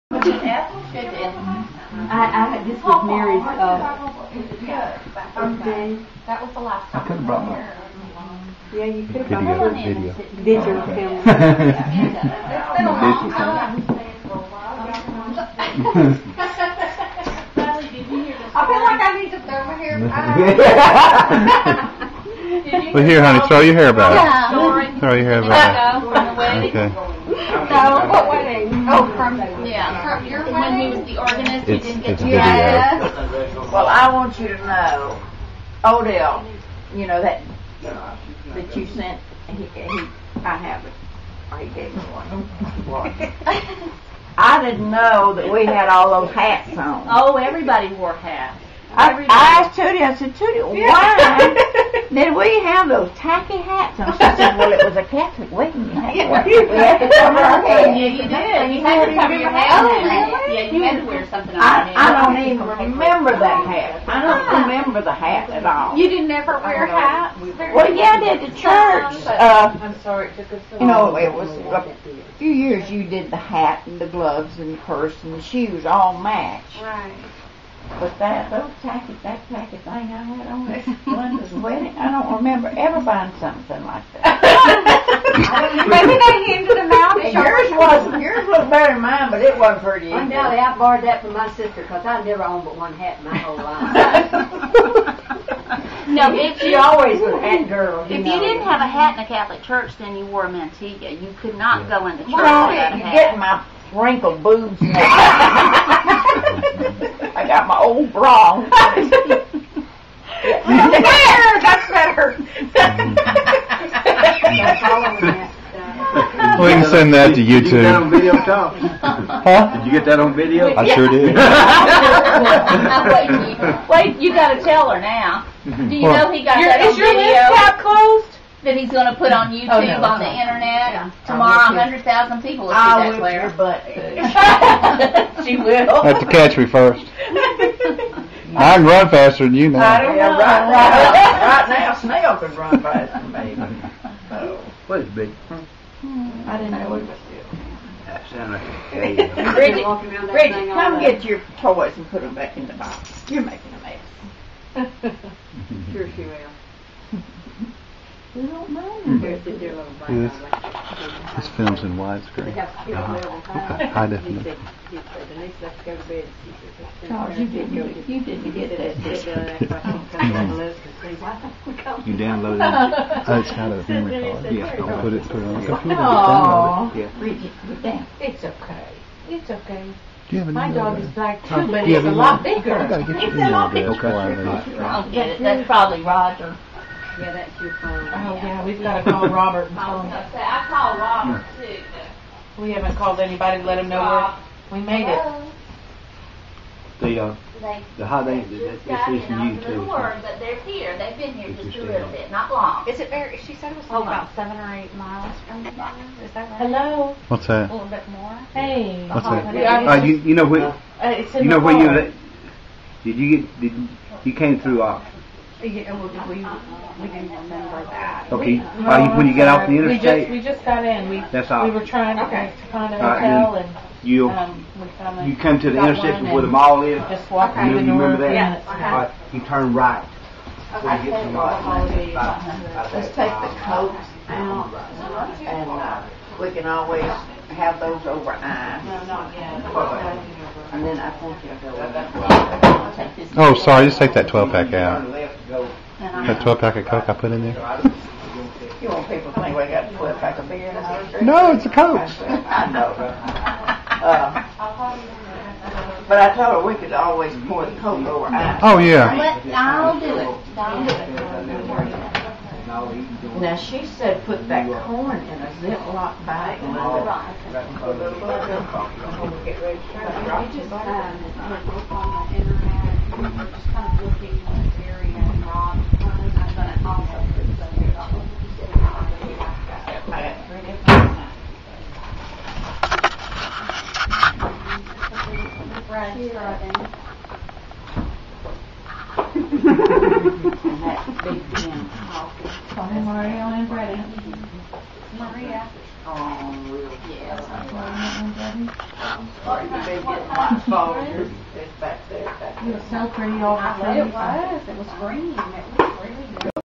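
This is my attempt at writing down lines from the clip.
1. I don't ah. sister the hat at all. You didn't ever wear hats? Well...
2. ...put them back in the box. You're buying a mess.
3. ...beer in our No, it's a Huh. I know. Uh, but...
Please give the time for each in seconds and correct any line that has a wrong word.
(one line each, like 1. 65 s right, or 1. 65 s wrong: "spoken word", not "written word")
1. 64 s wrong: "remember", not "sister"
2. 152 s wrong: "making", not "buying"
3. 250 s wrong: "Coke", not "Huh".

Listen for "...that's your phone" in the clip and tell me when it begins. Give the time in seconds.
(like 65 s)
187 s.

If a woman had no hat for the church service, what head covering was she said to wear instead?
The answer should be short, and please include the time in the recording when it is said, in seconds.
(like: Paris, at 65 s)
mantilla, at 100 s.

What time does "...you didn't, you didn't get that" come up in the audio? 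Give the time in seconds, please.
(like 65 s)
167 s.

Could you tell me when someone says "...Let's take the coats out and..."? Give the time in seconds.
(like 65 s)
232 s.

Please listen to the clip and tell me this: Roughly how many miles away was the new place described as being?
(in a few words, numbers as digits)
7 or 8 miles.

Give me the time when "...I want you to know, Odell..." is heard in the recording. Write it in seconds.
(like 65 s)
33 s.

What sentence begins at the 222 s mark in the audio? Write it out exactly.
to find a All uh, right, and, You, um, we found you come to the intersection where the mall is, just Okay.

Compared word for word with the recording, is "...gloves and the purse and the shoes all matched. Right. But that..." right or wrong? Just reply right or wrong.
right.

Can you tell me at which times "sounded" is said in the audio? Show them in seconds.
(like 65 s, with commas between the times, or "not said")
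148 s.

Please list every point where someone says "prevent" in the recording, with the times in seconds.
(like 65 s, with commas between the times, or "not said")
not said.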